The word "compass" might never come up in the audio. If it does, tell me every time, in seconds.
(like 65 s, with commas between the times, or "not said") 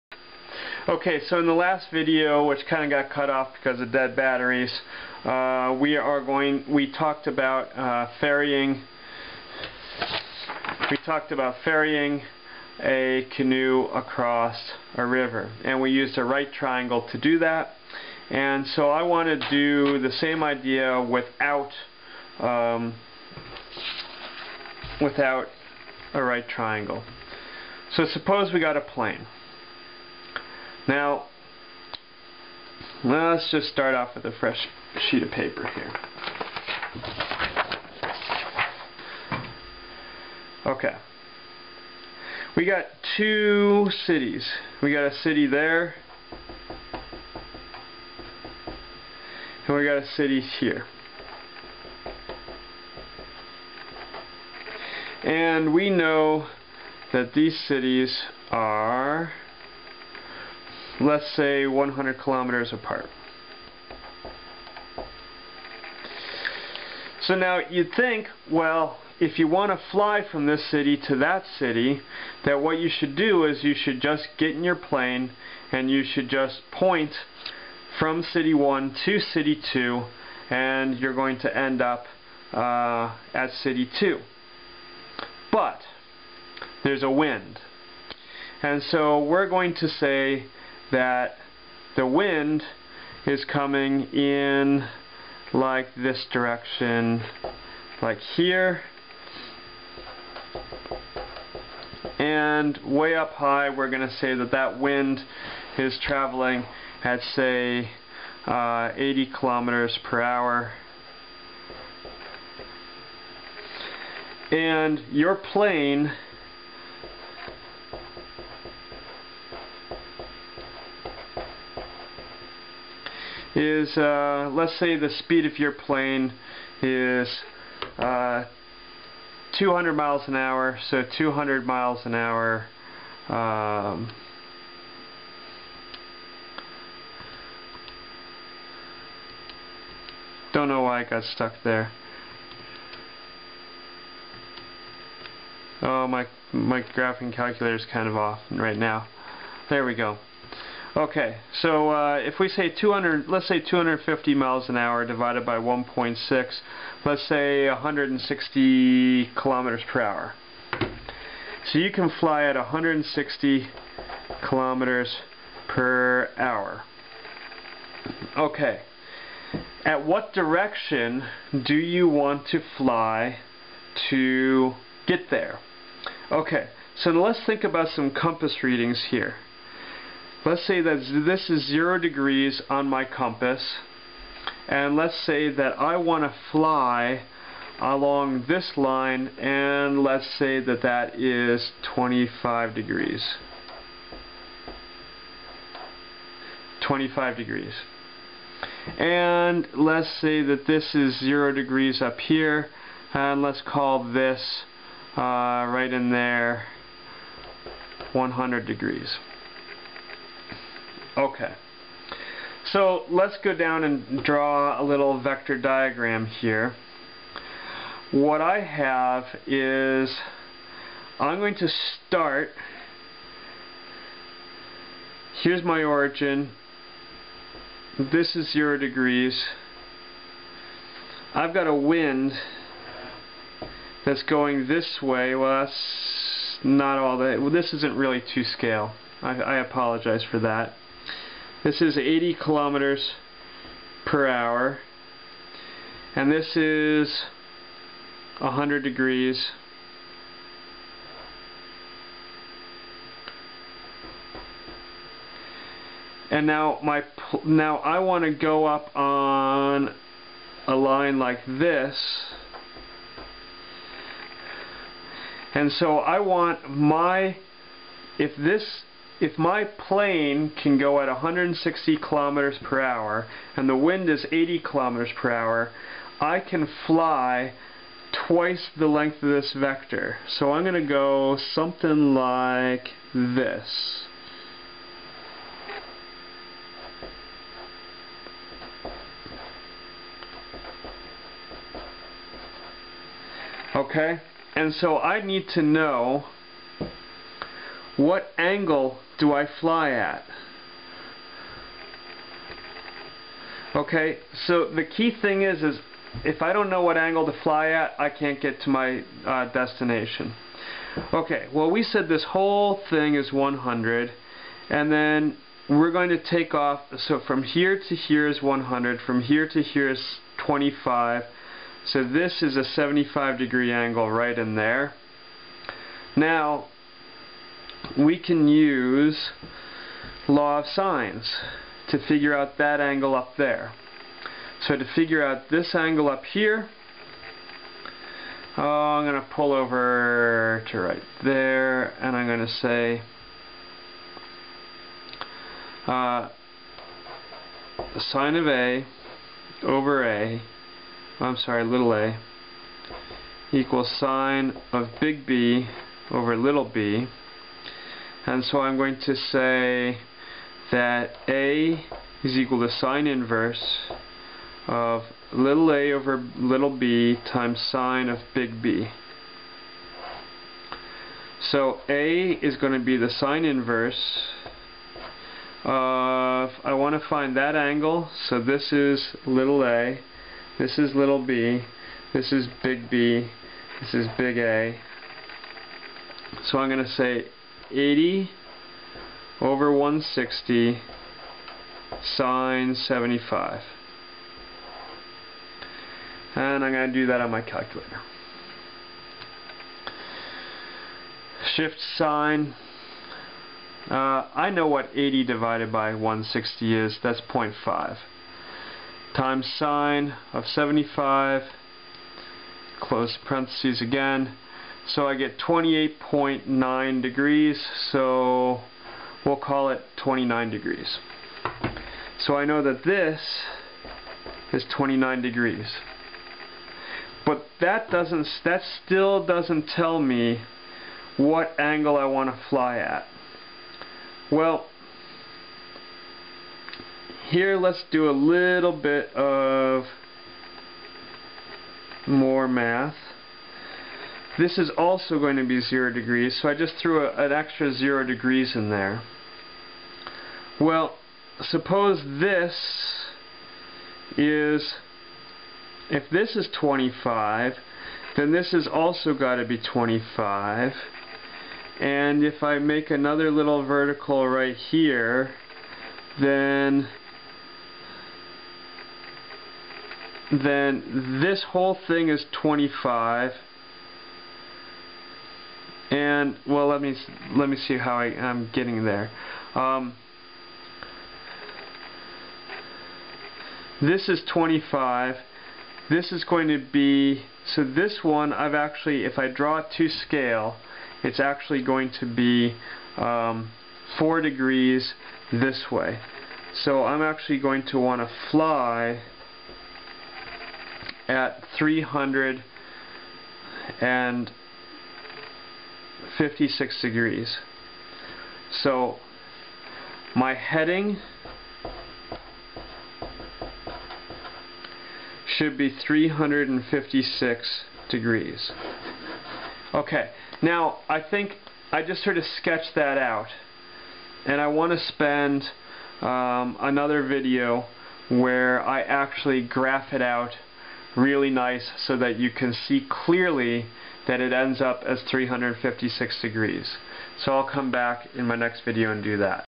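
178 s, 183 s.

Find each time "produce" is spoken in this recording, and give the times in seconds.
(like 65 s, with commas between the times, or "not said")
not said.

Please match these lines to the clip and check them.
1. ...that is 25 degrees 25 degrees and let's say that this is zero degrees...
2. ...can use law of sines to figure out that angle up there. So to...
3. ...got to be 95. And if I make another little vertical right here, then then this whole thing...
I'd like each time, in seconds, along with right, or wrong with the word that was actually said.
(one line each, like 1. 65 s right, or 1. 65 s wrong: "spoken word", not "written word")
1. 190 s right
2. 328 s right
3. 459 s wrong: "25", not "95".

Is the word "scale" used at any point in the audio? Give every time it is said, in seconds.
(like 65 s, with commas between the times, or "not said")
238 s, 489 s.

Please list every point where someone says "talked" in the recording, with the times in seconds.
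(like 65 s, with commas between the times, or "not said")
6 s, 11 s.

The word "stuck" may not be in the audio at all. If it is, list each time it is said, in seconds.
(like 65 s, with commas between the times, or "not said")
141 s.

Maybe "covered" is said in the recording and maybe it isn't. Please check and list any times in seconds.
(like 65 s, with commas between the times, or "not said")
not said.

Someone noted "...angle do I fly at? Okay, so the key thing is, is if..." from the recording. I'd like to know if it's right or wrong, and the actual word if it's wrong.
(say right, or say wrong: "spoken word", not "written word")
right.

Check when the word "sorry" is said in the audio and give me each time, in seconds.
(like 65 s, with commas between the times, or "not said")
351 s.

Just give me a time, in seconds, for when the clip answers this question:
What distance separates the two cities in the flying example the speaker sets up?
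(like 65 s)
61 s.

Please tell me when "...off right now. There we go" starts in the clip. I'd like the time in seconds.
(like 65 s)
148 s.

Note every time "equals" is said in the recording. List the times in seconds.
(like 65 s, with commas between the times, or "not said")
353 s, 362 s.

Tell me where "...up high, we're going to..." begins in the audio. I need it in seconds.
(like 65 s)
103 s.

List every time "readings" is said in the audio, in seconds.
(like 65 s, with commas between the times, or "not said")
178 s.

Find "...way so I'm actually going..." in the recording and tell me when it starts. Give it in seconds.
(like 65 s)
495 s.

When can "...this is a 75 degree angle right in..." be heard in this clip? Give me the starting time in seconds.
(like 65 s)
322 s.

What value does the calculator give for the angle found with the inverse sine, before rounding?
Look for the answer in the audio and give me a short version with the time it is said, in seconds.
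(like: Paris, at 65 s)
28.9 degrees, at 415 s.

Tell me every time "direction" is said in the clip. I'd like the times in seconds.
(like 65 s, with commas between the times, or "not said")
96 s, 170 s.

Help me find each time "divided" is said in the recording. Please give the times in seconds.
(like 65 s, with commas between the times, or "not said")
155 s, 405 s.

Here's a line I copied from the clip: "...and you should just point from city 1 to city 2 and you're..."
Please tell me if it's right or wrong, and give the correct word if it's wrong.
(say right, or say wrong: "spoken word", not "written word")
right.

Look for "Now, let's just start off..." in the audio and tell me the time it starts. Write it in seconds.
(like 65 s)
30 s.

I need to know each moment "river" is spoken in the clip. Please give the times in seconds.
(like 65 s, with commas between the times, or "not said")
15 s.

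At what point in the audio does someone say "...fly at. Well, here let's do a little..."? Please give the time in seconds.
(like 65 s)
432 s.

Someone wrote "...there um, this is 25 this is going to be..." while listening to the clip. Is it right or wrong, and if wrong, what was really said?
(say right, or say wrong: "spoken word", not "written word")
right.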